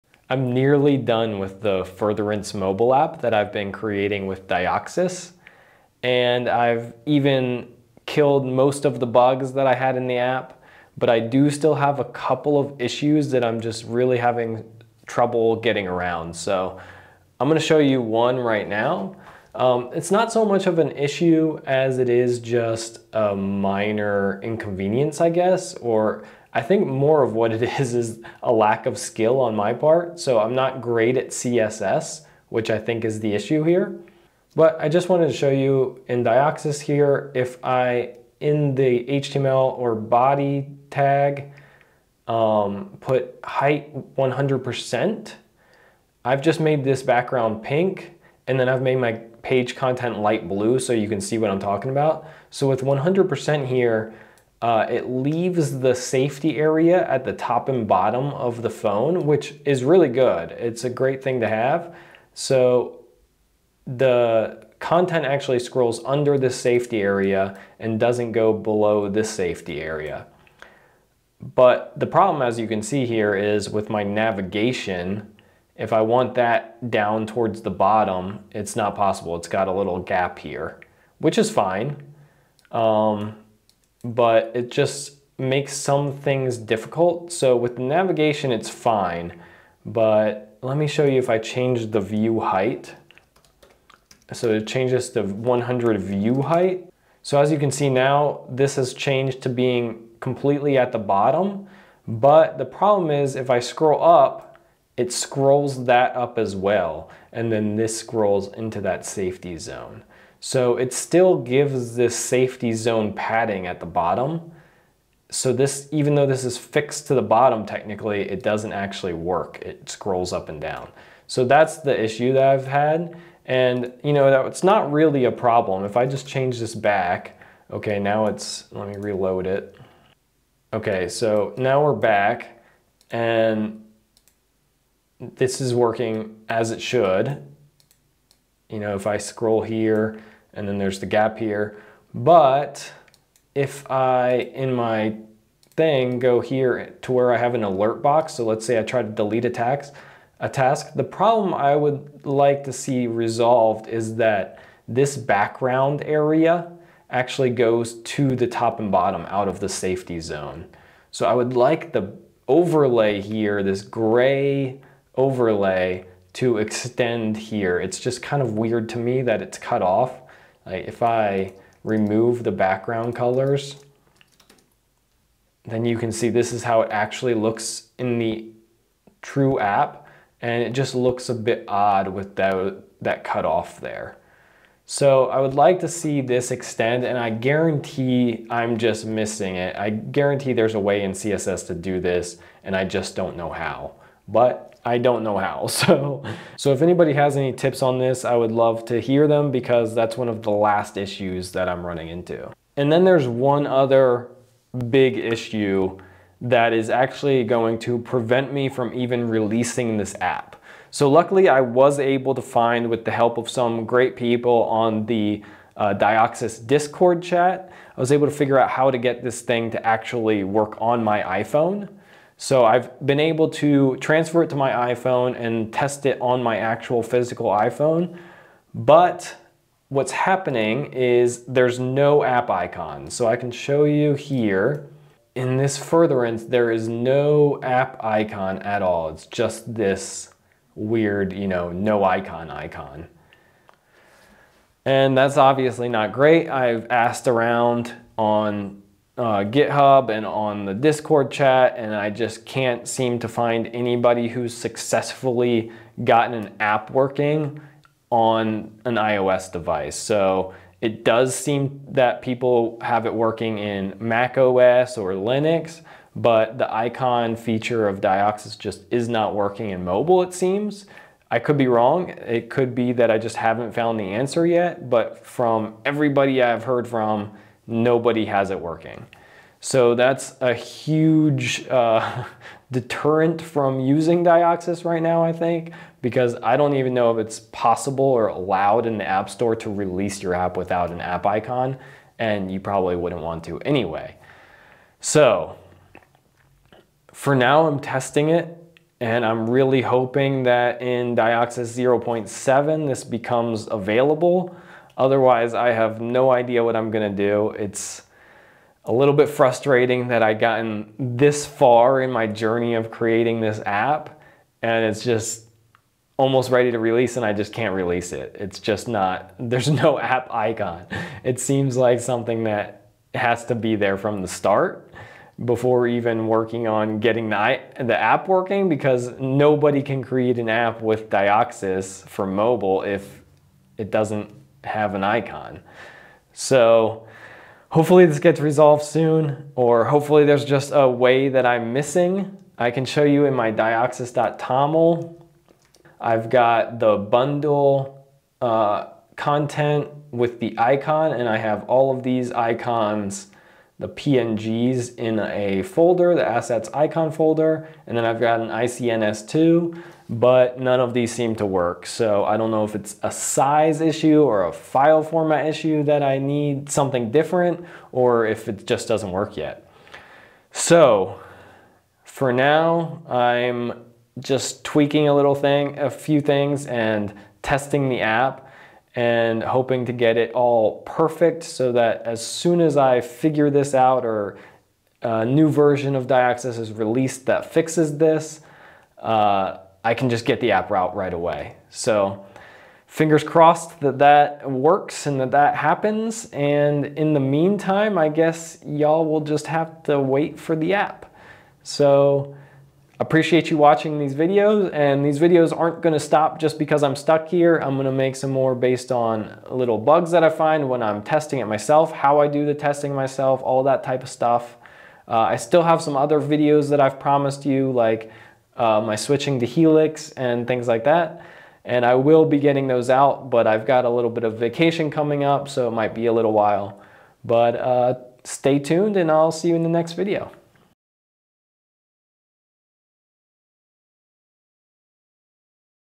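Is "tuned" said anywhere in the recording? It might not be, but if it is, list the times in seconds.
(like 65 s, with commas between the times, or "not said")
428 s.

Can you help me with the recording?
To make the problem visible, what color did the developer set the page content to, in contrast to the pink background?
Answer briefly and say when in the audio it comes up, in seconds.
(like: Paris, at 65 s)
Light blue, at 50 s.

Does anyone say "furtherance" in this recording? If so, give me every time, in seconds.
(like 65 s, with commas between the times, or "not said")
1 s, 235 s.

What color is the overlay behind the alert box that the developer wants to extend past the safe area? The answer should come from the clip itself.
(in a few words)
Gray.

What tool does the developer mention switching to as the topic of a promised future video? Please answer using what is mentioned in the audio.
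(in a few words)
Helix.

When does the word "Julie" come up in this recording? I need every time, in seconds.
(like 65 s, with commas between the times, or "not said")
not said.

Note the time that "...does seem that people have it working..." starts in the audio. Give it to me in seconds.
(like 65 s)
261 s.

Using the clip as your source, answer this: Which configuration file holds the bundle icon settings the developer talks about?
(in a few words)
dioxus.toml.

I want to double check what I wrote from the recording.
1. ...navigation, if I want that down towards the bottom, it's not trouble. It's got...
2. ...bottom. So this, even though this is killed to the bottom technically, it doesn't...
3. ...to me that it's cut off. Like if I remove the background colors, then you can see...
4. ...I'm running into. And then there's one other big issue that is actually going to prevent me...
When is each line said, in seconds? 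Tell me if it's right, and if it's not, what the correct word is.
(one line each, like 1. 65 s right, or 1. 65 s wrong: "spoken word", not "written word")
1. 74 s wrong: "possible", not "trouble"
2. 113 s wrong: "fixed", not "killed"
3. 168 s right
4. 201 s right.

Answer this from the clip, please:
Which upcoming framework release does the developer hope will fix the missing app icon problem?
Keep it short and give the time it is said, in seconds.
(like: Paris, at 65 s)
Dioxus 0.7, at 301 s.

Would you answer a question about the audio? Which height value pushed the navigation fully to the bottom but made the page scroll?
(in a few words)
100 view height.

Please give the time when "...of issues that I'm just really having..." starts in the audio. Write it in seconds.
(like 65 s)
12 s.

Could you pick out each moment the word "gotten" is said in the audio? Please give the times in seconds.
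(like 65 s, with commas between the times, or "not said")
256 s, 310 s.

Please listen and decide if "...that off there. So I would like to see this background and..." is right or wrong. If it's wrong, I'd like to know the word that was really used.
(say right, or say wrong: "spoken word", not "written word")
wrong: "extend", not "background".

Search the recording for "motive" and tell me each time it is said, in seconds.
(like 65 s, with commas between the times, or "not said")
not said.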